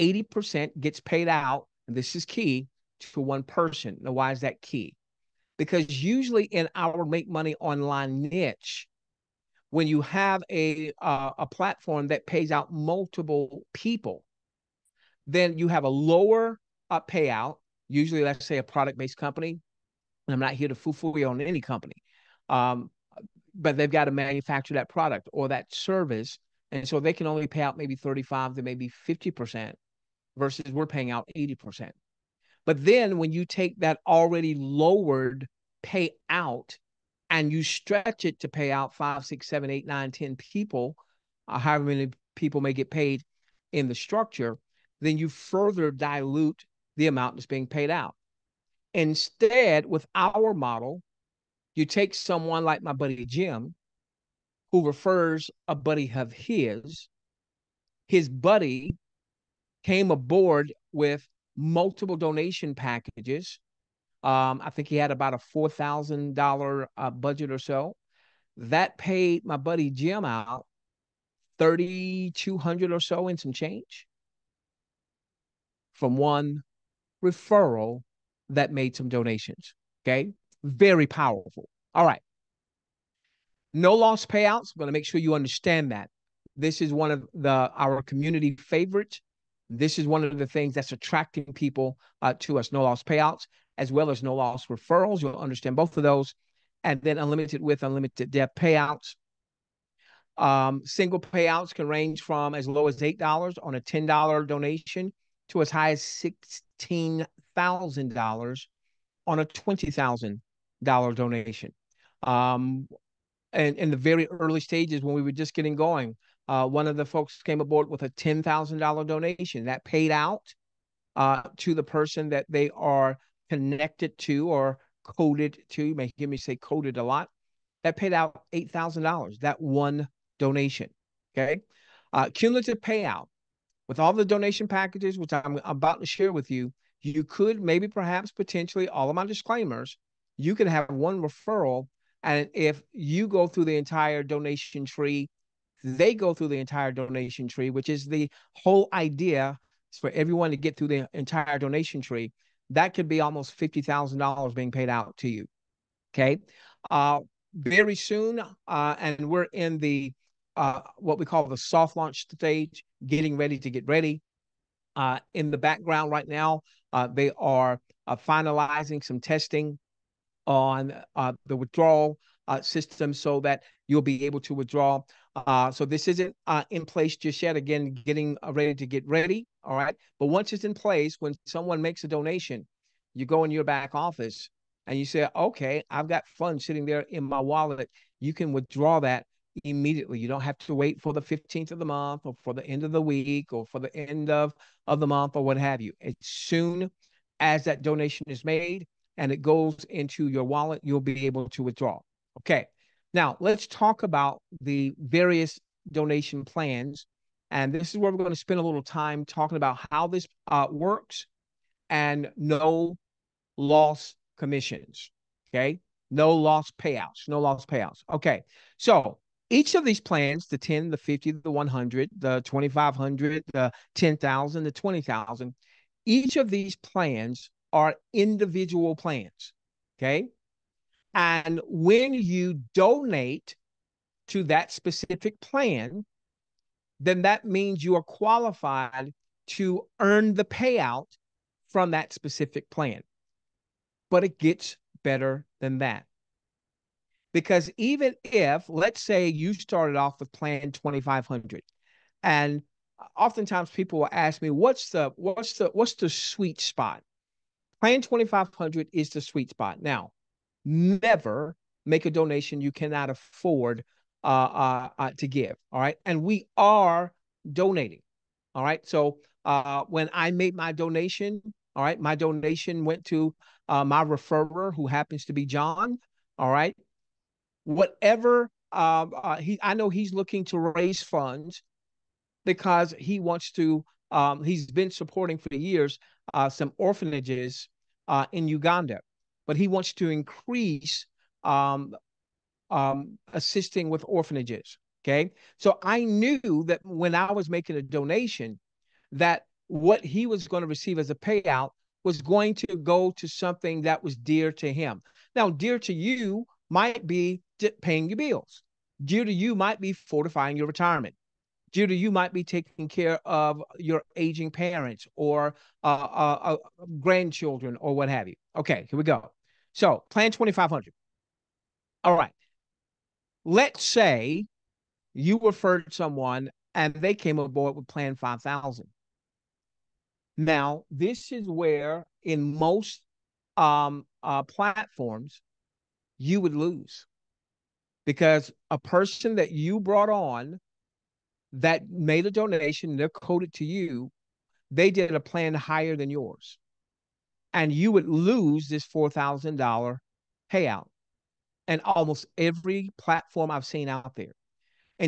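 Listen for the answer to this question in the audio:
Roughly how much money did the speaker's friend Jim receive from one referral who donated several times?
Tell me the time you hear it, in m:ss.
1:11.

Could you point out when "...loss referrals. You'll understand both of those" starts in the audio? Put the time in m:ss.
1:34.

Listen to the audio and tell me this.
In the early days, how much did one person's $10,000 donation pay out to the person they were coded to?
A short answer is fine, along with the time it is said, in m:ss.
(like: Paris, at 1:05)
$8,000, at 2:08.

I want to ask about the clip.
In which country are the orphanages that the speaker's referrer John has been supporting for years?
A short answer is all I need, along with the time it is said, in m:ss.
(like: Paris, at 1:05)
Uganda, at 4:48.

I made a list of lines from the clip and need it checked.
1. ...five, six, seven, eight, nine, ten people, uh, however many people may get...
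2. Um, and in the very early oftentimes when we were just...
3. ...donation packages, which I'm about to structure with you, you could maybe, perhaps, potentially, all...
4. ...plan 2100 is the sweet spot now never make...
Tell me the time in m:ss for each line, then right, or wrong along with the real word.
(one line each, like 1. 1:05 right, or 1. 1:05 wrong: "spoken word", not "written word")
1. 0:38 right
2. 1:52 wrong: "stages", not "oftentimes"
3. 2:14 wrong: "share", not "structure"
4. 4:17 wrong: "2500", not "2100".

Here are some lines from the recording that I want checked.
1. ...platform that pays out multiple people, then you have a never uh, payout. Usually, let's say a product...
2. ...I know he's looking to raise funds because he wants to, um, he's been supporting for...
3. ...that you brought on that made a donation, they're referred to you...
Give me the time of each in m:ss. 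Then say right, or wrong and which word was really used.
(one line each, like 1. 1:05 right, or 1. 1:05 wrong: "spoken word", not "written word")
1. 0:11 wrong: "lower", not "never"
2. 4:39 right
3. 5:39 wrong: "coded", not "referred".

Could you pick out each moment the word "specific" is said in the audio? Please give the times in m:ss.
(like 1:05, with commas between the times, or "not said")
3:54, 4:02.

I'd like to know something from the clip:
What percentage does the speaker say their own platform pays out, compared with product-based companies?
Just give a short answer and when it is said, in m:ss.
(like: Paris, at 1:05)
80 percent, at 0:31.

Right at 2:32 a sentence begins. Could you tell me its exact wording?
That could be almost $50,000 being paid out to you.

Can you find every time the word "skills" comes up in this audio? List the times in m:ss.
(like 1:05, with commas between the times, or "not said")
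not said.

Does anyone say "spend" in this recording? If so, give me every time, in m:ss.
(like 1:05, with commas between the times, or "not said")
3:28.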